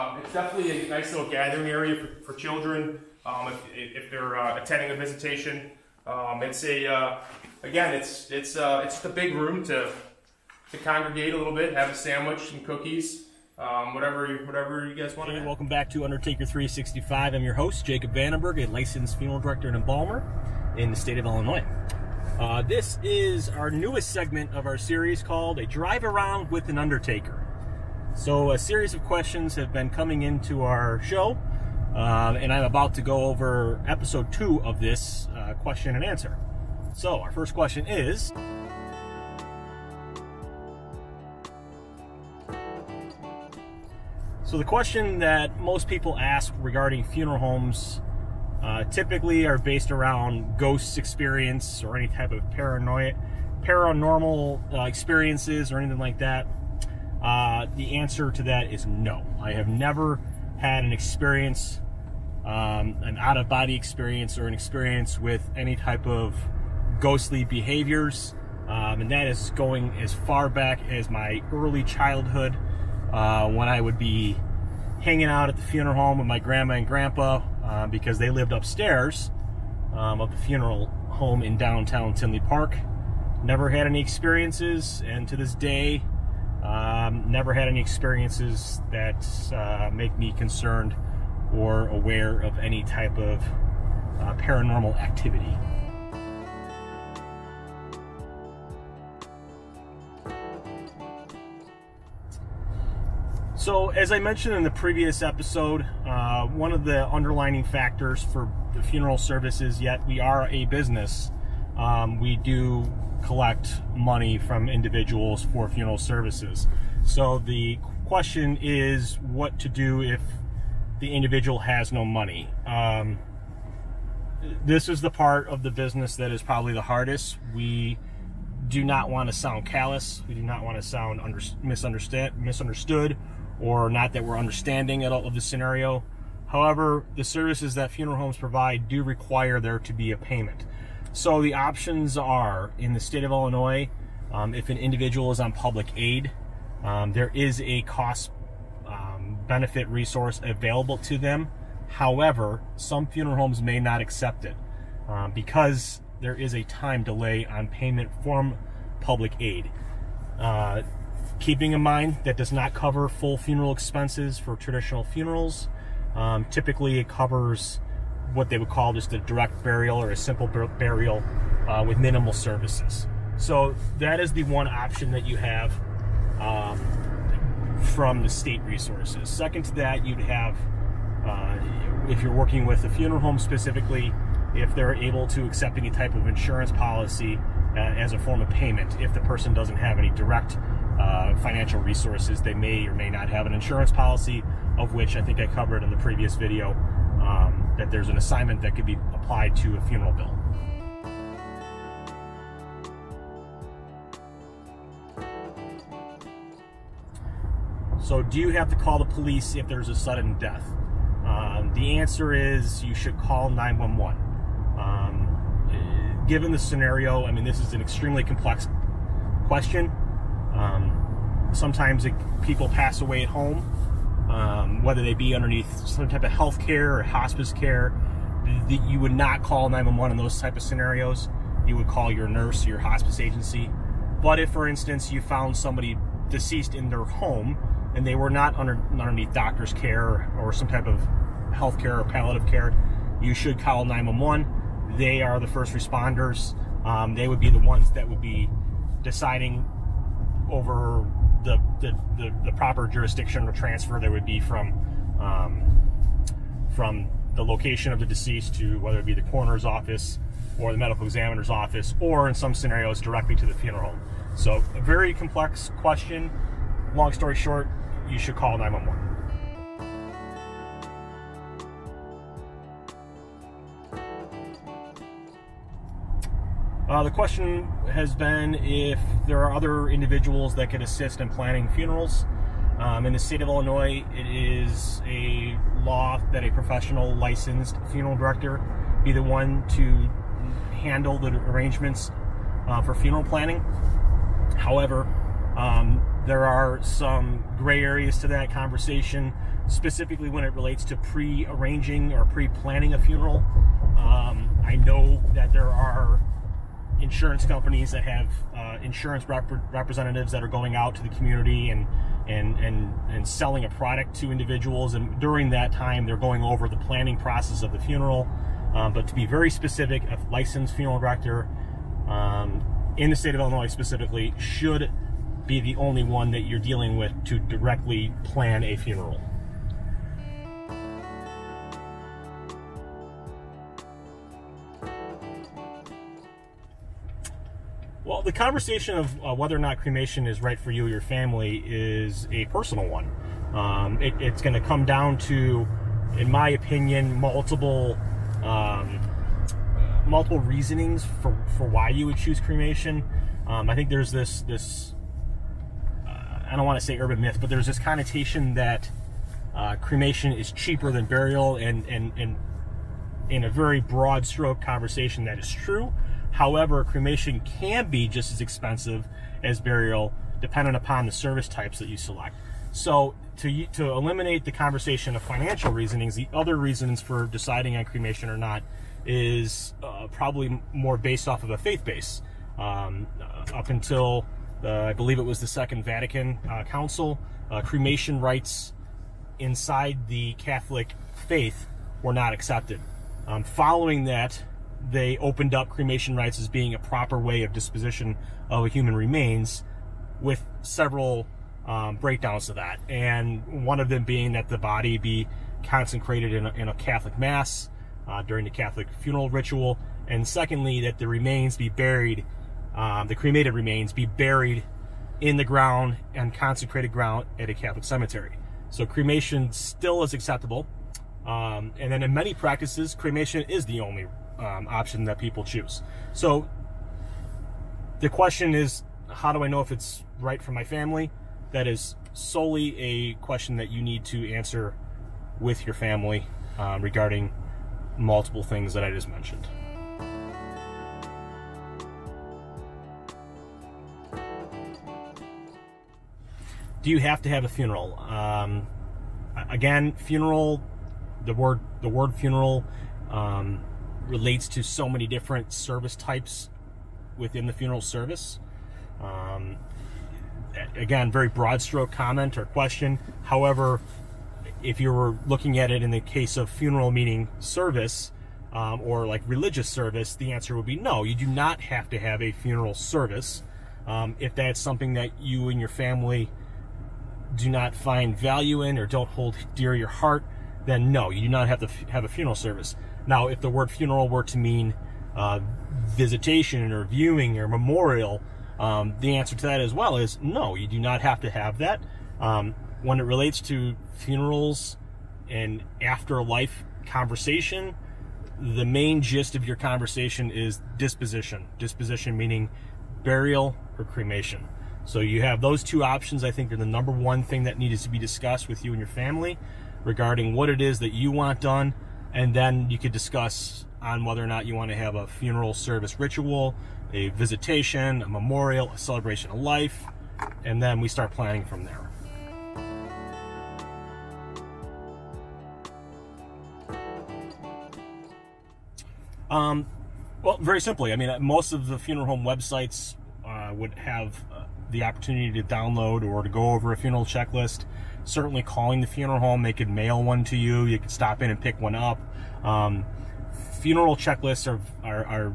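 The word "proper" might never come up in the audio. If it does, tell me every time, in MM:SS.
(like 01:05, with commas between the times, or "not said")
04:12, 06:36.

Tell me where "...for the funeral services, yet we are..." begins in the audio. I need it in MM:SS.
01:48.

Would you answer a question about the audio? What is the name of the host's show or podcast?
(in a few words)
Undertaker 365.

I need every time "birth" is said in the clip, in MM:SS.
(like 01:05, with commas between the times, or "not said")
not said.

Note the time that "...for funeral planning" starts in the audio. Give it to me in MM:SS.
04:52.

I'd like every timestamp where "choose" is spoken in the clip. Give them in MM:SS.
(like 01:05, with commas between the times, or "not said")
05:52, 07:05.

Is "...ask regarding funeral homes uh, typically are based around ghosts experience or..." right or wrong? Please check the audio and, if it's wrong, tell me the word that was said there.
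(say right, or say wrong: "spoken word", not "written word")
right.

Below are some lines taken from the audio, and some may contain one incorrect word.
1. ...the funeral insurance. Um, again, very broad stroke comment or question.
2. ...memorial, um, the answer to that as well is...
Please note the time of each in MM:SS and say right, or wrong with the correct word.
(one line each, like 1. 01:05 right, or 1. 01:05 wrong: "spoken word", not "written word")
1. 07:37 wrong: "service", not "insurance"
2. 08:07 right.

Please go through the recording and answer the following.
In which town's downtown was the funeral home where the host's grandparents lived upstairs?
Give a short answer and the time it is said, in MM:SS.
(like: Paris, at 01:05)
Tinley Park, at 01:22.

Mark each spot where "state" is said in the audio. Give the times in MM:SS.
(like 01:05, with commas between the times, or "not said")
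00:20, 02:22, 02:58, 04:43, 05:23.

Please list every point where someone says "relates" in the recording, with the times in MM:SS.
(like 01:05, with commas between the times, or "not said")
05:00, 07:34, 08:13.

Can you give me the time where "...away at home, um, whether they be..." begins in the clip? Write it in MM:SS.
03:42.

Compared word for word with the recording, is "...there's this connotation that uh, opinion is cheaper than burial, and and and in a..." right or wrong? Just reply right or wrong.
wrong.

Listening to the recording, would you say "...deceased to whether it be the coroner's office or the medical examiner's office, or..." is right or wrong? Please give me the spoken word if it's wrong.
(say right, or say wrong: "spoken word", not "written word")
right.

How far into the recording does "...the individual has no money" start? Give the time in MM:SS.
02:01.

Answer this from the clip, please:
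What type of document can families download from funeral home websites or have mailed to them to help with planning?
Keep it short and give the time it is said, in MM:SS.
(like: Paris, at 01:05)
funeral checklist, at 08:56.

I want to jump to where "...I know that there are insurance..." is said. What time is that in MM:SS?
05:04.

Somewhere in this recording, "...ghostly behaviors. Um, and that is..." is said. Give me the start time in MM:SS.
01:06.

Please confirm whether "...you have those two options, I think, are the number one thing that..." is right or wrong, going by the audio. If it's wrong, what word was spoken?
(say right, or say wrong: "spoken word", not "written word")
right.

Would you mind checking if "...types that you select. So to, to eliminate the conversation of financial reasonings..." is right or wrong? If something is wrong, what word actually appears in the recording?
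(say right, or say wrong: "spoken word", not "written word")
right.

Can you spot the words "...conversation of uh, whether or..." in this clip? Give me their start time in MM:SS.
05:38.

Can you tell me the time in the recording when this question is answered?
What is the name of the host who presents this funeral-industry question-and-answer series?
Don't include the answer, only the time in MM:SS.
00:17.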